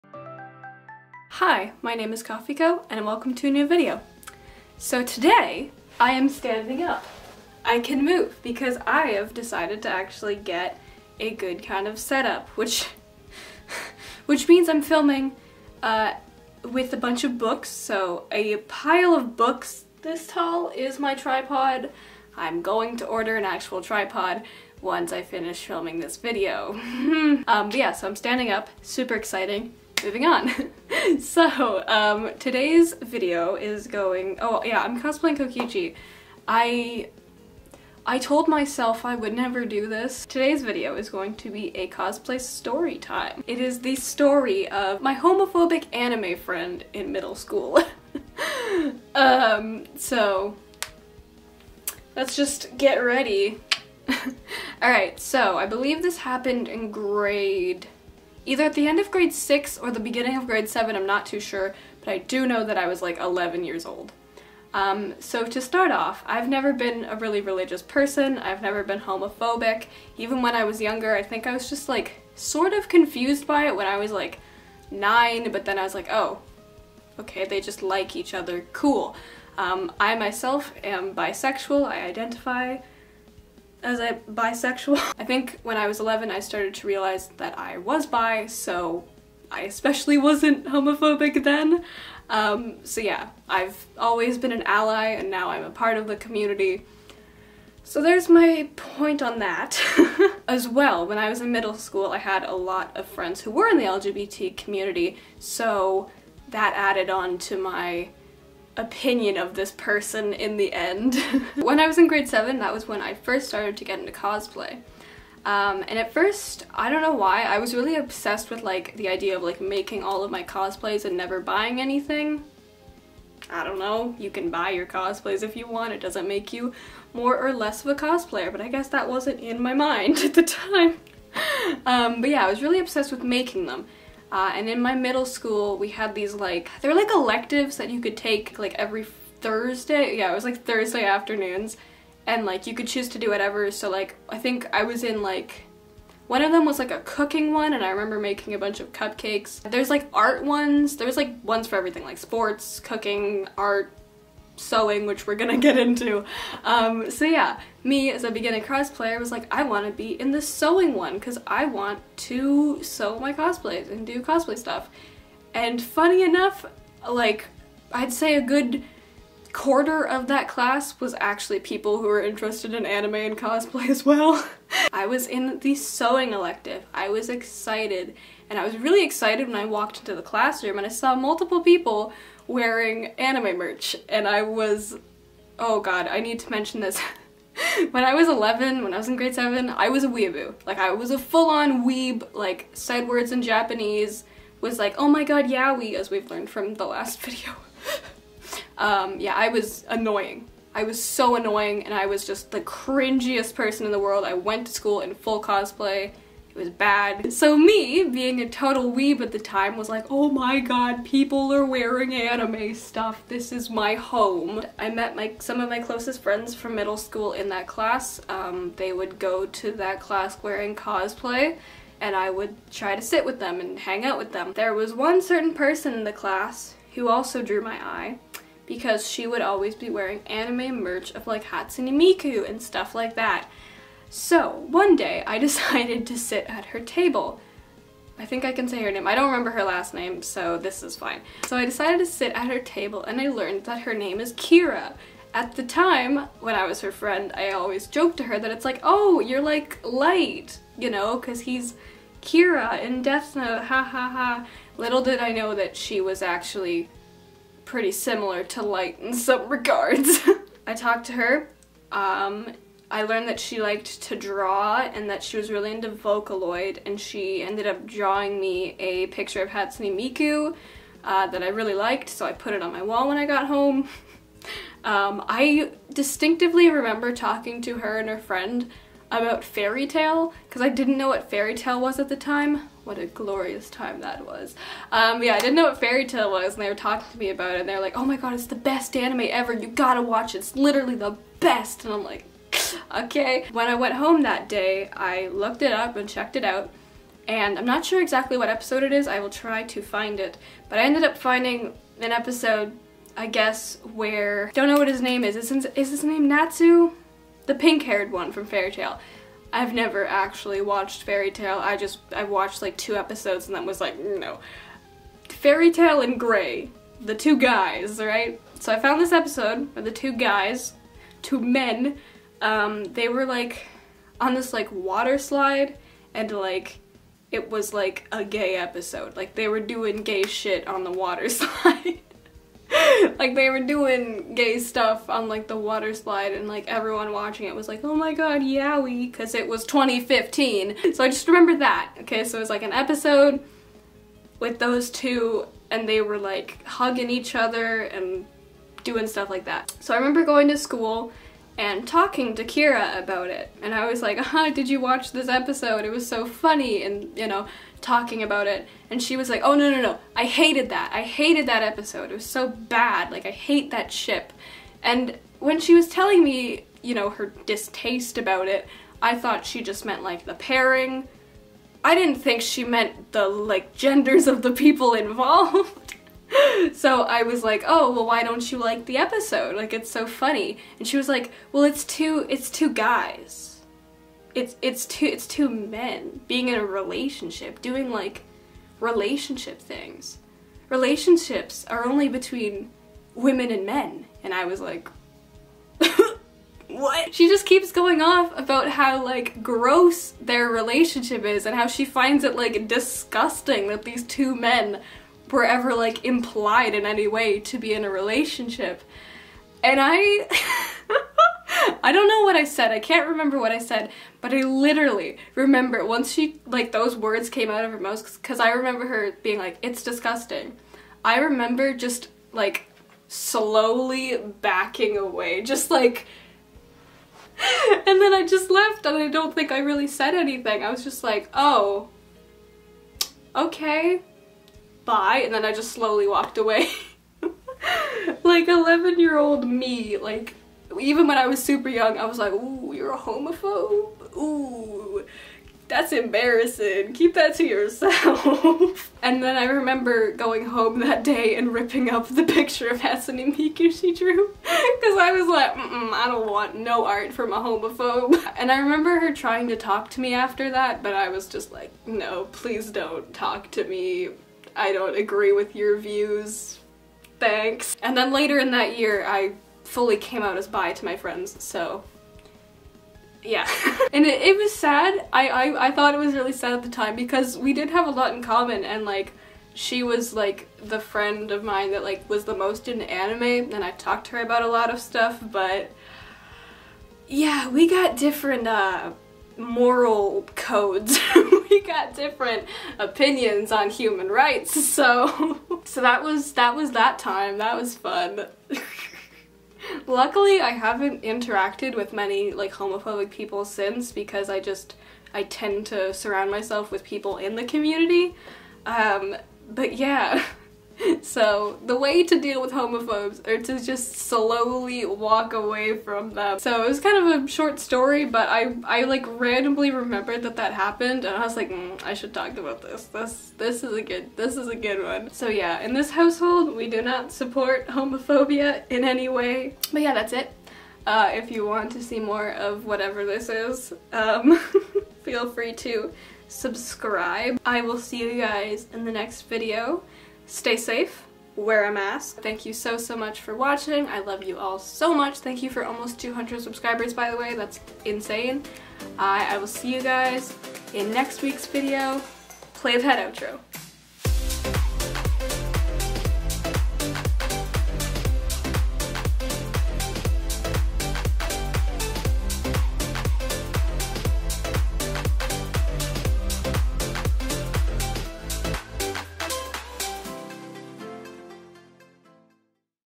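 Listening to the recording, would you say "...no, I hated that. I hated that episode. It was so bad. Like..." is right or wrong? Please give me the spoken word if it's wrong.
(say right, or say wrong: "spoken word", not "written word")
right.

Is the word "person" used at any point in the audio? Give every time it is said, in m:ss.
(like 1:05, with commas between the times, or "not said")
1:07, 1:49, 3:23, 3:45.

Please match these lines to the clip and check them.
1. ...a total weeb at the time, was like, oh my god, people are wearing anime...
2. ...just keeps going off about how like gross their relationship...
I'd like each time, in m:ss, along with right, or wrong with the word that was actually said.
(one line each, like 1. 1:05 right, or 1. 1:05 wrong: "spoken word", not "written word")
1. 3:28 right
2. 6:37 right.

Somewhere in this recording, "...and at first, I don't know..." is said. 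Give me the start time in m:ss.
1:55.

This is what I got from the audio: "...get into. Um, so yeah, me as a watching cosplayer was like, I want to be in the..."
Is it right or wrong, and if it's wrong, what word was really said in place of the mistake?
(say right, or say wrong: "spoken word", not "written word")
wrong: "beginning", not "watching".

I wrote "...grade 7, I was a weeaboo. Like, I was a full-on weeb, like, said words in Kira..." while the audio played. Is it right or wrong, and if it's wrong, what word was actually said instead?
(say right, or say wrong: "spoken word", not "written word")
wrong: "Japanese", not "Kira".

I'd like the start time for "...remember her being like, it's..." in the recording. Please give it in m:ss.
6:58.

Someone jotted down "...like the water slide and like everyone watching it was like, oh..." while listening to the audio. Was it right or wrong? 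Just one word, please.
right.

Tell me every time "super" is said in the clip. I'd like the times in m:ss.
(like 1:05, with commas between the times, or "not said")
0:28, 7:21.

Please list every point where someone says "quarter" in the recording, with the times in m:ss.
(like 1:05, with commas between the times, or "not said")
2:49.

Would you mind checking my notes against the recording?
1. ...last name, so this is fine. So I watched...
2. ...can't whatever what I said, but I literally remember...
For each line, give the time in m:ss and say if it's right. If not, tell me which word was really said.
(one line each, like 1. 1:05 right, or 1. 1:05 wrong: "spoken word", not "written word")
1. 3:59 wrong: "decided", not "watched"
2. 6:52 wrong: "remember", not "whatever".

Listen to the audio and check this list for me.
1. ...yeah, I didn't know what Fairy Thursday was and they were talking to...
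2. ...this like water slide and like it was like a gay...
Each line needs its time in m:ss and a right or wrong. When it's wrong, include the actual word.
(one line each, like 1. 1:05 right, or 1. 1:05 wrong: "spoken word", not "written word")
1. 4:45 wrong: "Tail", not "Thursday"
2. 5:24 right.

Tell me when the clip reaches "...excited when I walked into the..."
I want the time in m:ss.
2:59.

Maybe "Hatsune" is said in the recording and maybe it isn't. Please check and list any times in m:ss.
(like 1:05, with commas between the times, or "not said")
3:51, 4:29, 7:32.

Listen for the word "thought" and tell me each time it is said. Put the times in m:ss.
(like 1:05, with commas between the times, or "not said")
6:09, 7:55.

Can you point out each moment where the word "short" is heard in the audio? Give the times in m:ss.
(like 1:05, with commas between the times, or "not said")
8:37.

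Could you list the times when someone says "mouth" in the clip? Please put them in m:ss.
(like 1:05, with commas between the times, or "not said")
6:57.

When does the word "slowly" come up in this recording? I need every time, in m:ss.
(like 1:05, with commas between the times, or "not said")
7:03, 7:15, 8:33.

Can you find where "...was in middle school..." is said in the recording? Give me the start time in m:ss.
1:41.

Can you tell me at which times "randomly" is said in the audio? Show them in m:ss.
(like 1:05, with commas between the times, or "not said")
8:39.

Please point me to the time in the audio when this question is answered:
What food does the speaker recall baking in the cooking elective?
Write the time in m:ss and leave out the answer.
2:28.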